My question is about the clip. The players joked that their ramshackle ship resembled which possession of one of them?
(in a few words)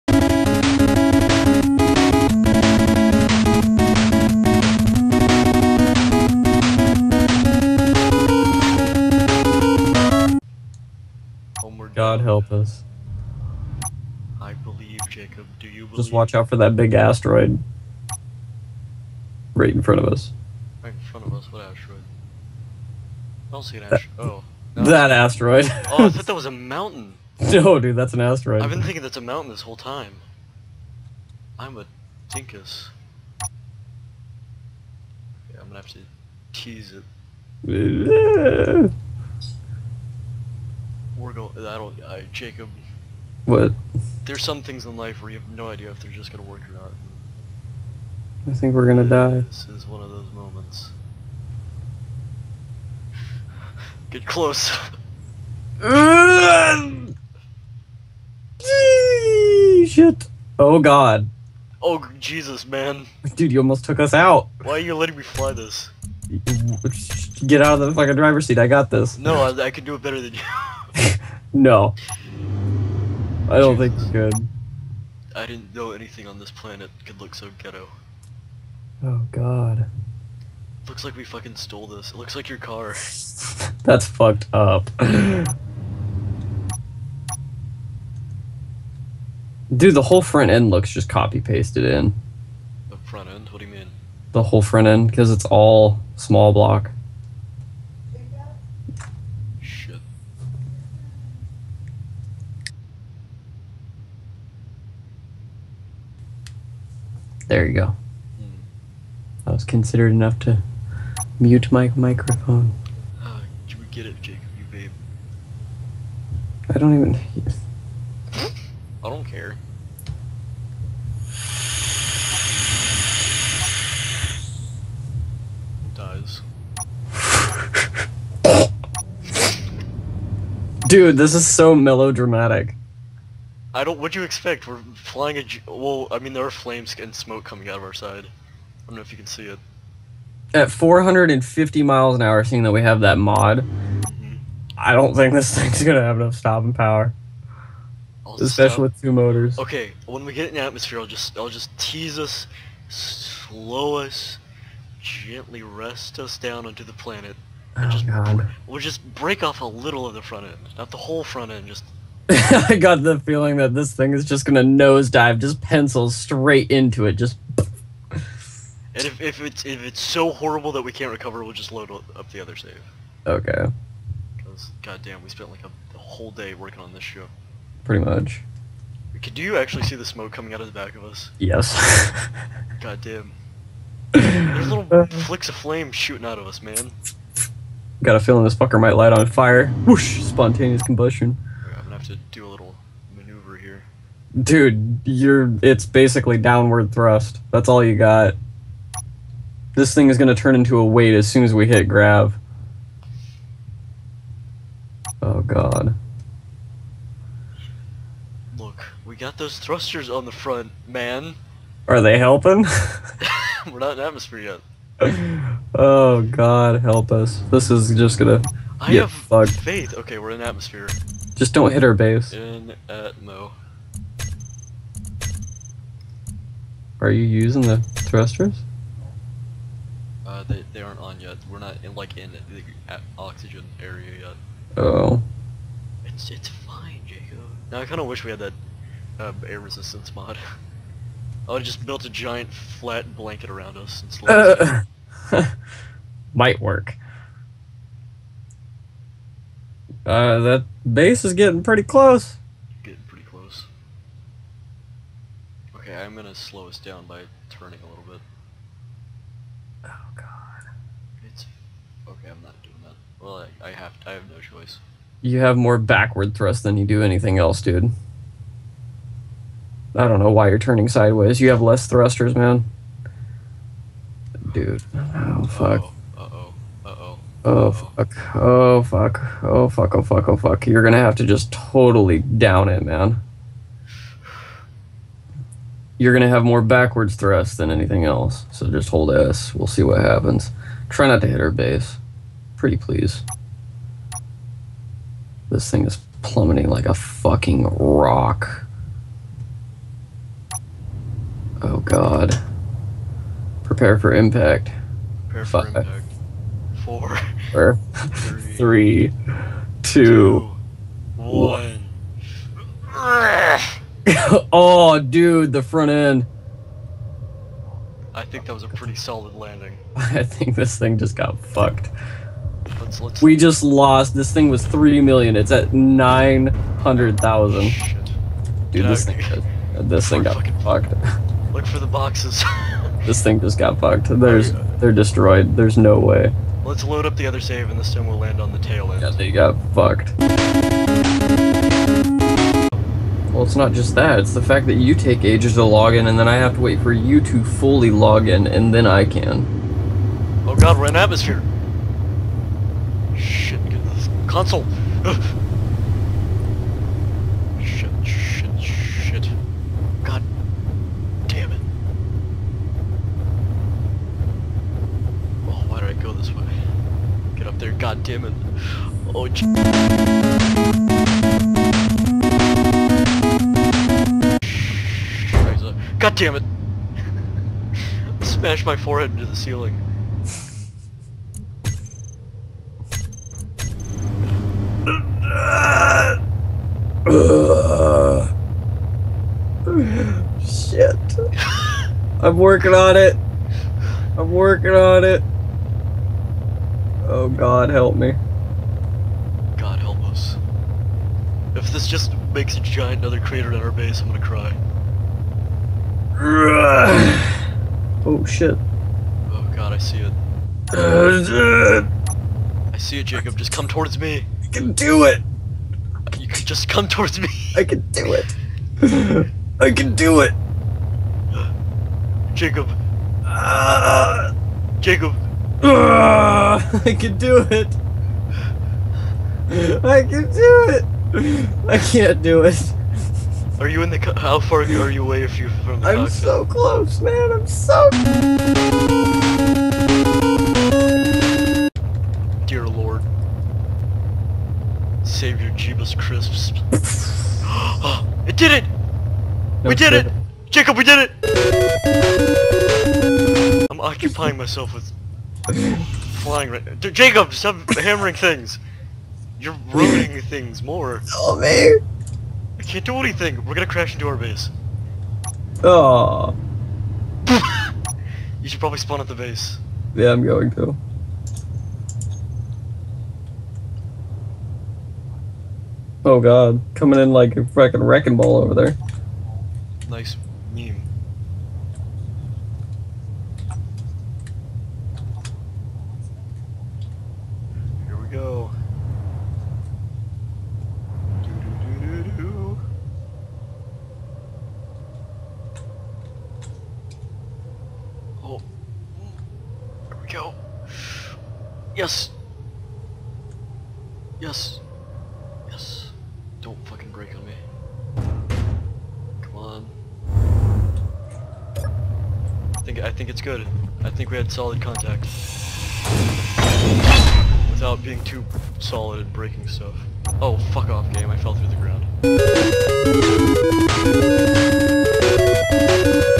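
Your car.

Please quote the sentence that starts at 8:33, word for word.
I think we had solid contact.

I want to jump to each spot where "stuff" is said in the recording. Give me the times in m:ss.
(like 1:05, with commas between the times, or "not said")
8:39.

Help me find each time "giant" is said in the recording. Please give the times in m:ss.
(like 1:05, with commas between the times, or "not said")
4:02, 6:42.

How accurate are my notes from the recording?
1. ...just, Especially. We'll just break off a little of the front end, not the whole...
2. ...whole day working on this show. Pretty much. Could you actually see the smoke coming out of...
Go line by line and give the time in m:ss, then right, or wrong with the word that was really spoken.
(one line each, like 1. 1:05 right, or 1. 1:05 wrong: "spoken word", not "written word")
1. 2:37 wrong: "God", not "Especially"
2. 2:55 right.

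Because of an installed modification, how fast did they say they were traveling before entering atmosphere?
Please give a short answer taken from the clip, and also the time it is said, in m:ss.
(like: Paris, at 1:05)
450 miles an hour, at 2:20.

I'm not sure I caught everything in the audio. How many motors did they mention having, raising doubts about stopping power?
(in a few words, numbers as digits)
2.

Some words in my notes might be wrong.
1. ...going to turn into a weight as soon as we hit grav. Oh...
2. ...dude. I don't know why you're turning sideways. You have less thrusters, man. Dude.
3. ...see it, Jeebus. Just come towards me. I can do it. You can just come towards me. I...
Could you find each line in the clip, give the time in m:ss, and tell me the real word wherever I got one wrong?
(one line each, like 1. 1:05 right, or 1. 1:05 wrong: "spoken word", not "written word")
1. 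3:20 right
2. 4:27 right
3. 6:52 wrong: "Jacob", not "Jeebus".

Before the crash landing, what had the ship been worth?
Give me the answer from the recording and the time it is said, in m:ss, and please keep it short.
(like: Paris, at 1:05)
3 million, at 5:24.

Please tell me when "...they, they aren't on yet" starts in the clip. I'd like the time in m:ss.
3:50.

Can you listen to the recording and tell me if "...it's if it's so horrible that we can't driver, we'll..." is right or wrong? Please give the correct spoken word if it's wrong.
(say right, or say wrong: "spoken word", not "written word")
wrong: "recover", not "driver".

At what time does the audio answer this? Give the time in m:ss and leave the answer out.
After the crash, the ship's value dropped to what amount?
5:25.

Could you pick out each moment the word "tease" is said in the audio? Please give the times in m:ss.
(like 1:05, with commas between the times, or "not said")
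0:36, 2:31.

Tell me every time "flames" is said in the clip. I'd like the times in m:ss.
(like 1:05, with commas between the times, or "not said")
2:16, 3:05.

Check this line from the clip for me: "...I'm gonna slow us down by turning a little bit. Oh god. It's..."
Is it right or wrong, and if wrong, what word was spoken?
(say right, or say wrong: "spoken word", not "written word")
right.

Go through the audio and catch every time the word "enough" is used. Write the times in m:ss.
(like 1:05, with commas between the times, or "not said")
1:50, 2:26.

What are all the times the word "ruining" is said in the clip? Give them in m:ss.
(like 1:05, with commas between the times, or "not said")
7:39.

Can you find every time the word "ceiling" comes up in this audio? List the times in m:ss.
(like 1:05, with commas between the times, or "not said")
6:19.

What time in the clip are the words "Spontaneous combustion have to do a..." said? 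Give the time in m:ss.
3:10.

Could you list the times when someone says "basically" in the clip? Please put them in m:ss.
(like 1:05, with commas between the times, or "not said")
3:15.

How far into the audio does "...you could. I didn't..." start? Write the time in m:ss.
1:13.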